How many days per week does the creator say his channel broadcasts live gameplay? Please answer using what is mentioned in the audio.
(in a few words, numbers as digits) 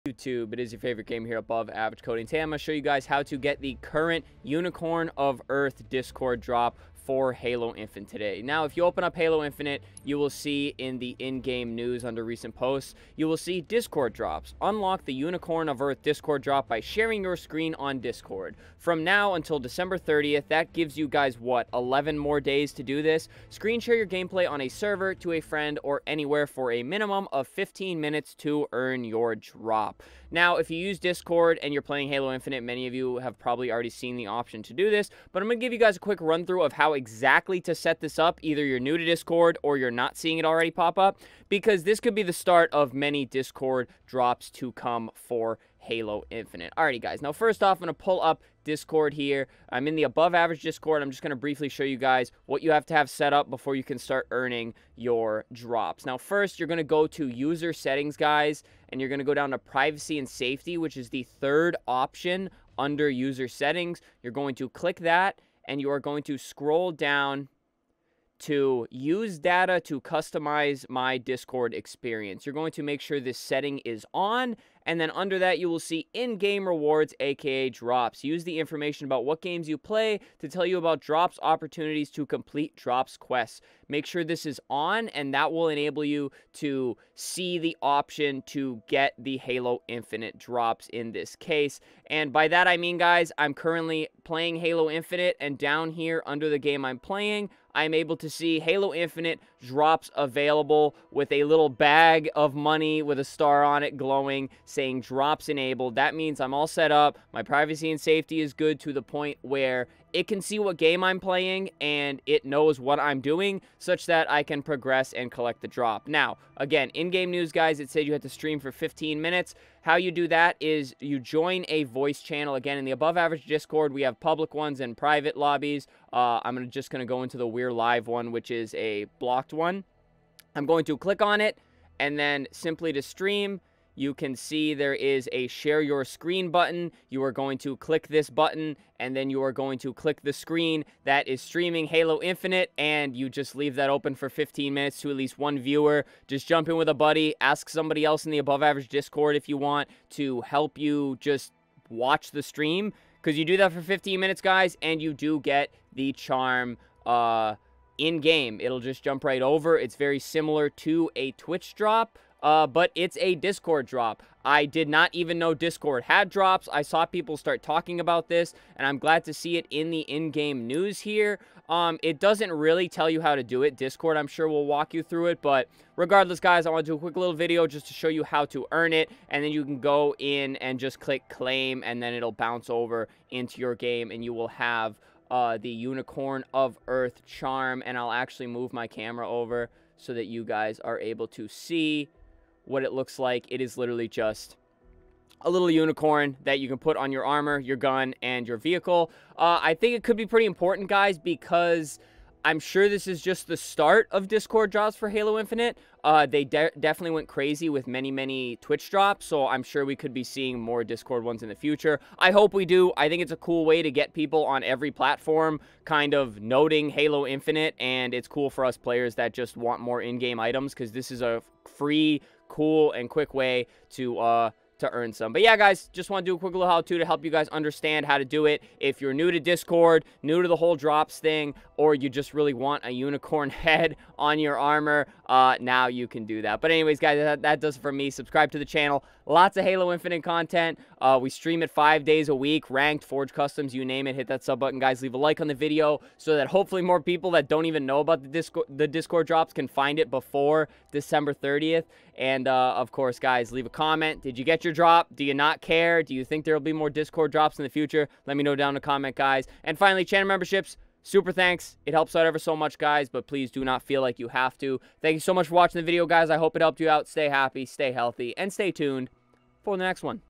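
5.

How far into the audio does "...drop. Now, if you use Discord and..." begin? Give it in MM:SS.
00:29.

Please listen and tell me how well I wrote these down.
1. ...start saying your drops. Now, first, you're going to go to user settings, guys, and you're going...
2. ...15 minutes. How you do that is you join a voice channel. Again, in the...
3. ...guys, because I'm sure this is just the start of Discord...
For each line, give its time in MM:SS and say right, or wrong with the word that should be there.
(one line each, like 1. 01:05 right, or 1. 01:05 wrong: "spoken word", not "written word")
1. 00:53 wrong: "earning", not "saying"
2. 01:58 right
3. 03:20 right.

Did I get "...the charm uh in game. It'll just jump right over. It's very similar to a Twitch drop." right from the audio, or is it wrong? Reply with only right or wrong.
right.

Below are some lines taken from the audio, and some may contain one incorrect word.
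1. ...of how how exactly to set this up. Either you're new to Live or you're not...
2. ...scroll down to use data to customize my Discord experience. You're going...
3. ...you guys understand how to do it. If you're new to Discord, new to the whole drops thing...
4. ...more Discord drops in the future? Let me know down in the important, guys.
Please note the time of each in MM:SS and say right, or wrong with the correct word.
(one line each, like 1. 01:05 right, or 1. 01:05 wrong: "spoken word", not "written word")
1. 00:36 wrong: "Discord", not "Live"
2. 01:06 right
3. 03:47 right
4. 04:16 wrong: "comment", not "important".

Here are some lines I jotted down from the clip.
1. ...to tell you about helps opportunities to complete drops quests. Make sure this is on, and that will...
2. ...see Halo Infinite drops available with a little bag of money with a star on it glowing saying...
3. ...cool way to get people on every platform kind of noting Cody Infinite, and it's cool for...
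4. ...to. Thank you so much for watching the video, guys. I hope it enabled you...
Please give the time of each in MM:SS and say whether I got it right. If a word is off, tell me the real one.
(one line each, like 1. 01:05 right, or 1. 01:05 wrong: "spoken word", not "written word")
1. 01:20 wrong: "drops", not "helps"
2. 01:38 right
3. 03:33 wrong: "Halo", not "Cody"
4. 04:24 wrong: "helped", not "enabled".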